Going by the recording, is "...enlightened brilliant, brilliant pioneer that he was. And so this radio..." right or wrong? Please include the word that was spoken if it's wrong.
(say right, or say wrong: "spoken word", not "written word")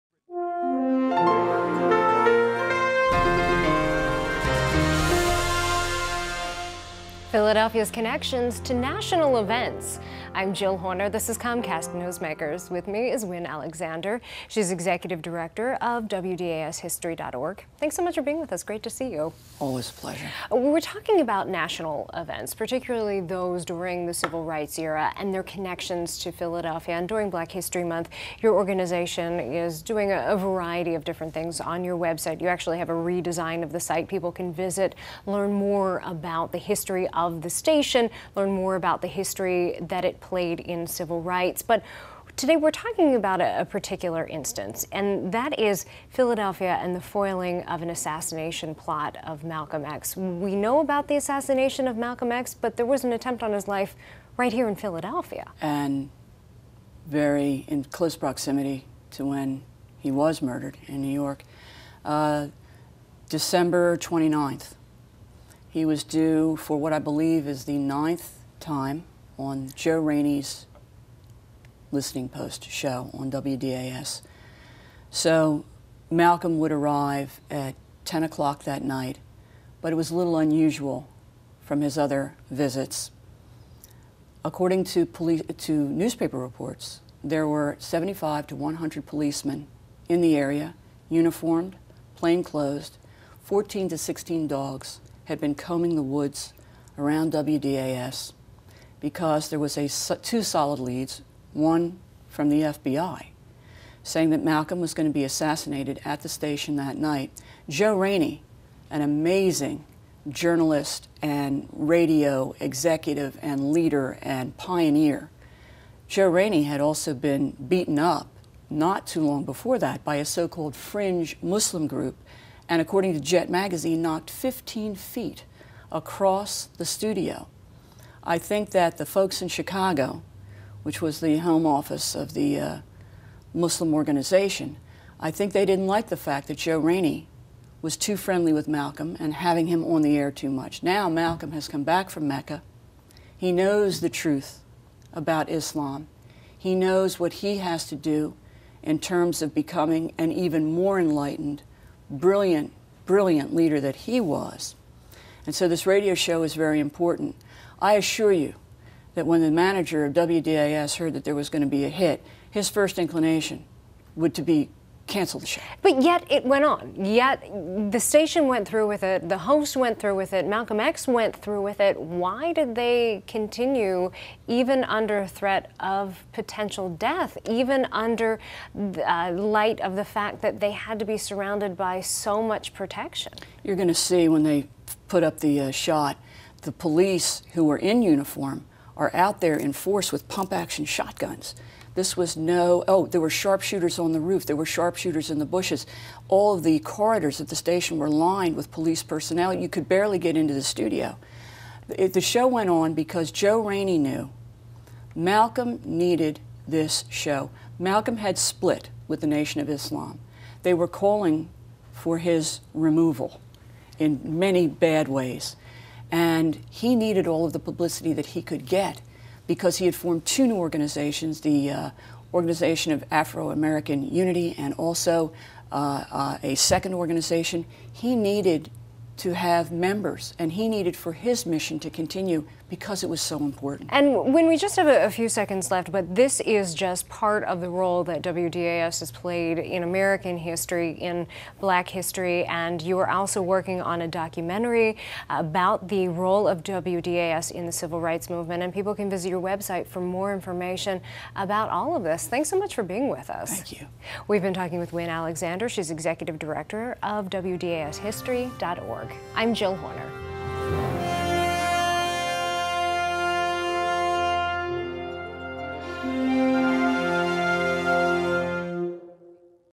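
wrong: "leader", not "pioneer".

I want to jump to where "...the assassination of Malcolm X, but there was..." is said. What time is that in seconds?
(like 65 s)
51 s.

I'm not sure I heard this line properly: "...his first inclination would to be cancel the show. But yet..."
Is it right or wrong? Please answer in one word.
right.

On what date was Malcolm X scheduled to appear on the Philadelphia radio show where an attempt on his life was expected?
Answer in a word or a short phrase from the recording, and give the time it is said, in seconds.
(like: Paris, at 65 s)
December 29th, at 63 s.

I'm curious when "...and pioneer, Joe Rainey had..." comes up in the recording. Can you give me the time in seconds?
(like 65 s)
114 s.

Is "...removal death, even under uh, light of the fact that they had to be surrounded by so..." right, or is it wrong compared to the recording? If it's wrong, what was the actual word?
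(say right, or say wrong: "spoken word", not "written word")
wrong: "potential", not "removal".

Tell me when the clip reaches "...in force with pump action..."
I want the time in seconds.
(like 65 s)
189 s.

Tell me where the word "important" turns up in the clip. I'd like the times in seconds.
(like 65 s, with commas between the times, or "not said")
156 s, 233 s.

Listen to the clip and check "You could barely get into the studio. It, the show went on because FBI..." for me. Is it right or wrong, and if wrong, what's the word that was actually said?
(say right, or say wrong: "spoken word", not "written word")
wrong: "Joe", not "FBI".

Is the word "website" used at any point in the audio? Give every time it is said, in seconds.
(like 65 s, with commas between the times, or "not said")
31 s, 249 s.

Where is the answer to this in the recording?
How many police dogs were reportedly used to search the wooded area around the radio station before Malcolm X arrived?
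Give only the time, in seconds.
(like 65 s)
93 s.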